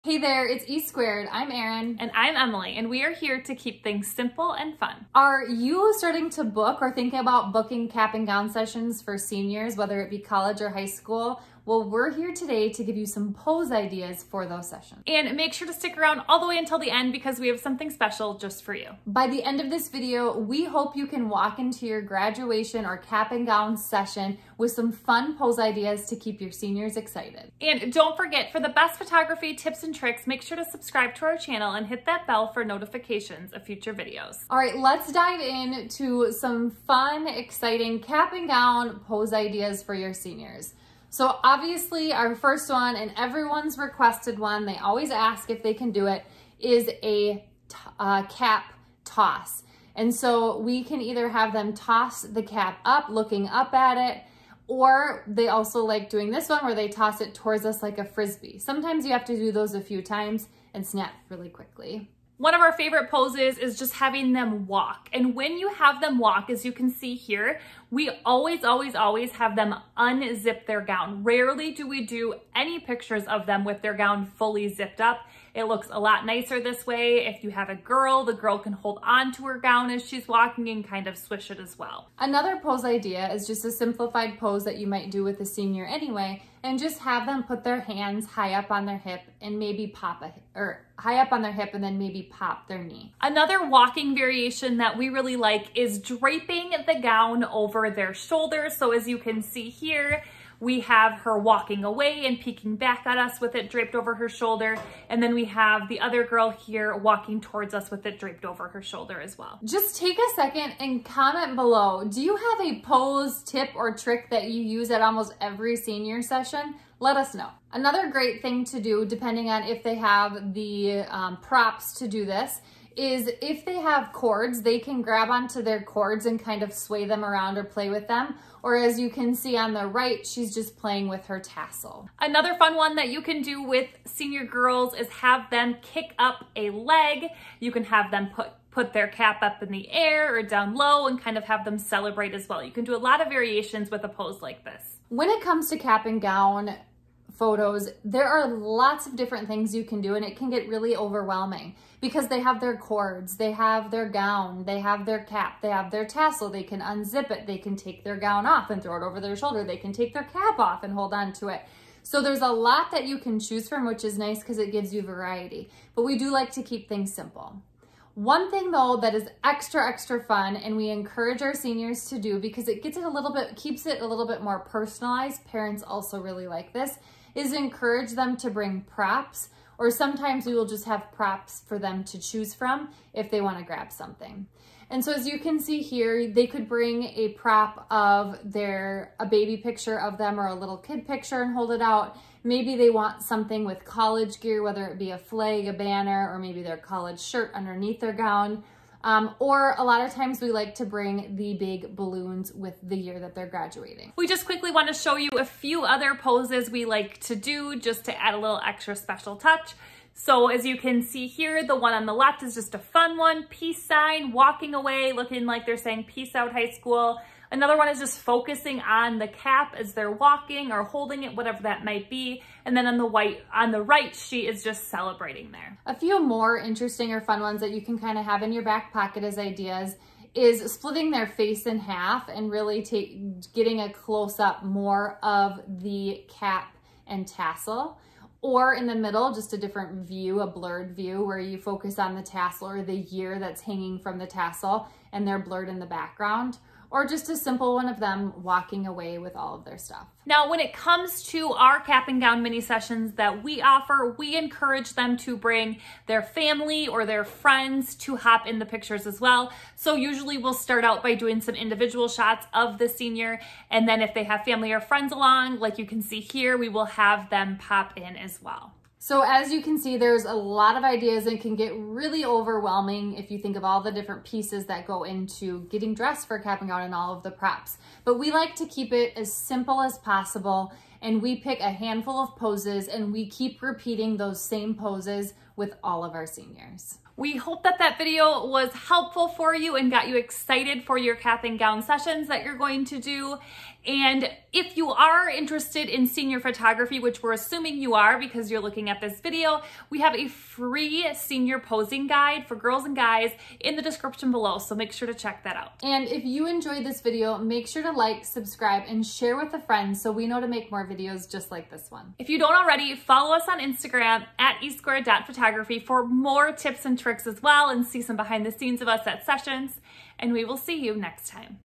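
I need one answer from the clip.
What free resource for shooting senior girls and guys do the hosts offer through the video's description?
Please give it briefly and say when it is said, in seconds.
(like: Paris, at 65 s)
senior posing guide, at 301 s.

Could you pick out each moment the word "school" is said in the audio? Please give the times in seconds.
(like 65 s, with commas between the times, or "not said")
10 s, 216 s.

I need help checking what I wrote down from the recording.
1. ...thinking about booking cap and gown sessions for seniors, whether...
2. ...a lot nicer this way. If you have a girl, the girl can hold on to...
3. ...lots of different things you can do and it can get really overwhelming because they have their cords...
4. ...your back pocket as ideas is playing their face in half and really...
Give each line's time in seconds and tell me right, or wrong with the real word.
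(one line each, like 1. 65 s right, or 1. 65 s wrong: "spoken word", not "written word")
1. 6 s right
2. 75 s right
3. 148 s right
4. 228 s wrong: "splitting", not "playing".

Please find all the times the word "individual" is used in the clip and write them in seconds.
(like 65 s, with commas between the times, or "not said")
261 s.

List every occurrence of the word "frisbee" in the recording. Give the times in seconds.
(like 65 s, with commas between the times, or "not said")
58 s.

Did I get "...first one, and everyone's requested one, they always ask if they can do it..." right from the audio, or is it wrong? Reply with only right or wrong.
right.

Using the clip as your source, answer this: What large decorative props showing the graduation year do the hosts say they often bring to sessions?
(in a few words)
big balloons.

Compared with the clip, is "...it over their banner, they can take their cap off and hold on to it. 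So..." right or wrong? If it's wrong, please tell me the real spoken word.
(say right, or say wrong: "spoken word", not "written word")
wrong: "shoulder", not "banner".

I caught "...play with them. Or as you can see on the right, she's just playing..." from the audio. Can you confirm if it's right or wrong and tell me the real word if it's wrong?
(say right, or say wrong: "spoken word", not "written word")
right.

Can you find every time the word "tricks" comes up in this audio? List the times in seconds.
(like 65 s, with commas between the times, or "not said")
29 s, 113 s, 316 s.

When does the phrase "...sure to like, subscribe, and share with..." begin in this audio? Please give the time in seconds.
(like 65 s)
307 s.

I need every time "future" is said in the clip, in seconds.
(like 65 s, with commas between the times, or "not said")
33 s.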